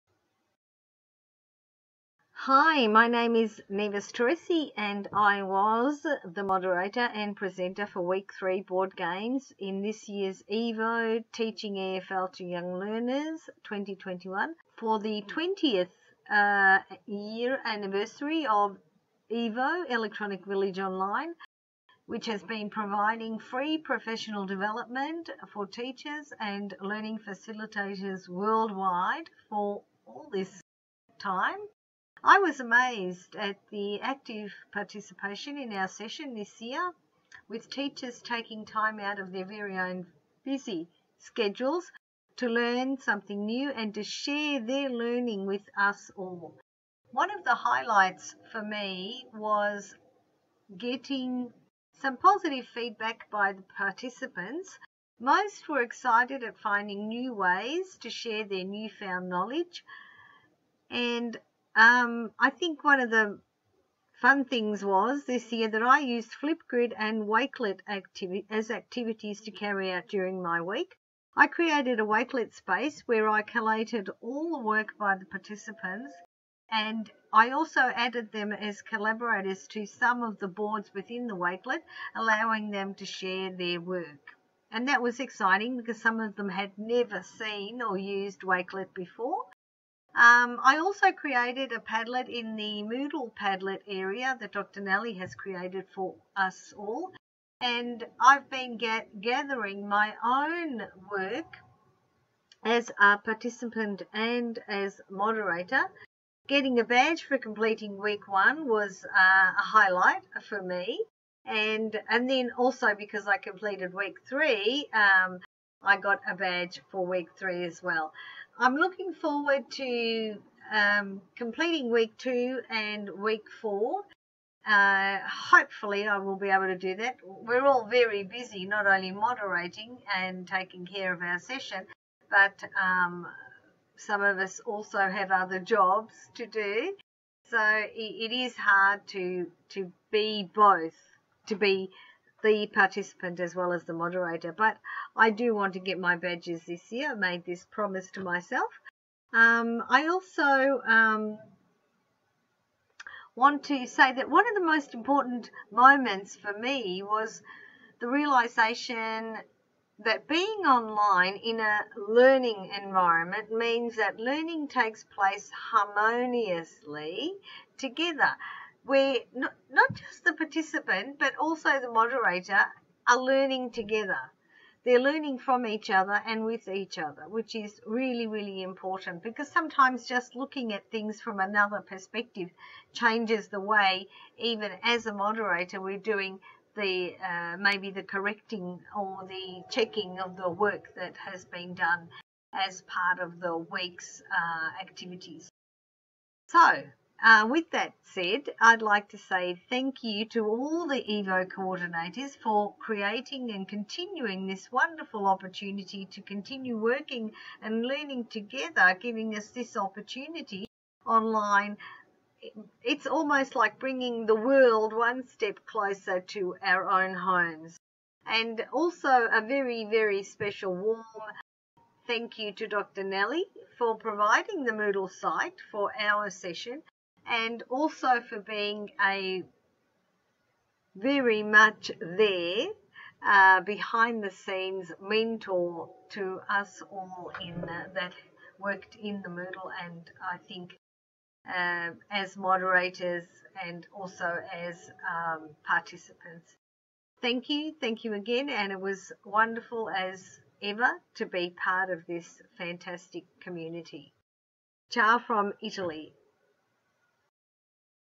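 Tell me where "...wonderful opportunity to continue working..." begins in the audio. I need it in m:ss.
3:24.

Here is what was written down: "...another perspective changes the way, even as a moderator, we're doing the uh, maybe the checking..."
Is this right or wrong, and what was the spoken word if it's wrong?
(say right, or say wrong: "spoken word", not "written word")
wrong: "correcting", not "checking".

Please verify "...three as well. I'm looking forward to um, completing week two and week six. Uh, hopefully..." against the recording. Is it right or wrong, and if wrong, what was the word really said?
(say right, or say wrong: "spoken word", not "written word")
wrong: "four", not "six".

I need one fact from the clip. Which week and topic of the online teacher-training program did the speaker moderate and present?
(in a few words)
Week 3 Board Games.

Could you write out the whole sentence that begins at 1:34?
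Nellie has created for us all.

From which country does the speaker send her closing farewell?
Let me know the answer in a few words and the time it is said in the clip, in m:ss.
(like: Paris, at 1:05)
Italy, at 4:15.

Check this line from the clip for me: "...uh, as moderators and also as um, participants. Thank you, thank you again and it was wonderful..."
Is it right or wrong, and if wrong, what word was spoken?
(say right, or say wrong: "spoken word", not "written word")
right.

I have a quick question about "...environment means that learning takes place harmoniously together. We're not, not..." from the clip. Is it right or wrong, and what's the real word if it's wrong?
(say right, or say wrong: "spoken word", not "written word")
right.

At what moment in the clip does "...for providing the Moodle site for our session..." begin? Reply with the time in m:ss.
3:43.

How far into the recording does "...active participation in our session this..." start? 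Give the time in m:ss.
0:33.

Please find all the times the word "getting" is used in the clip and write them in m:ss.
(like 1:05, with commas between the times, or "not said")
0:50, 1:46.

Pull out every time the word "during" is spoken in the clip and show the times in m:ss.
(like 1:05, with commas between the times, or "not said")
1:10.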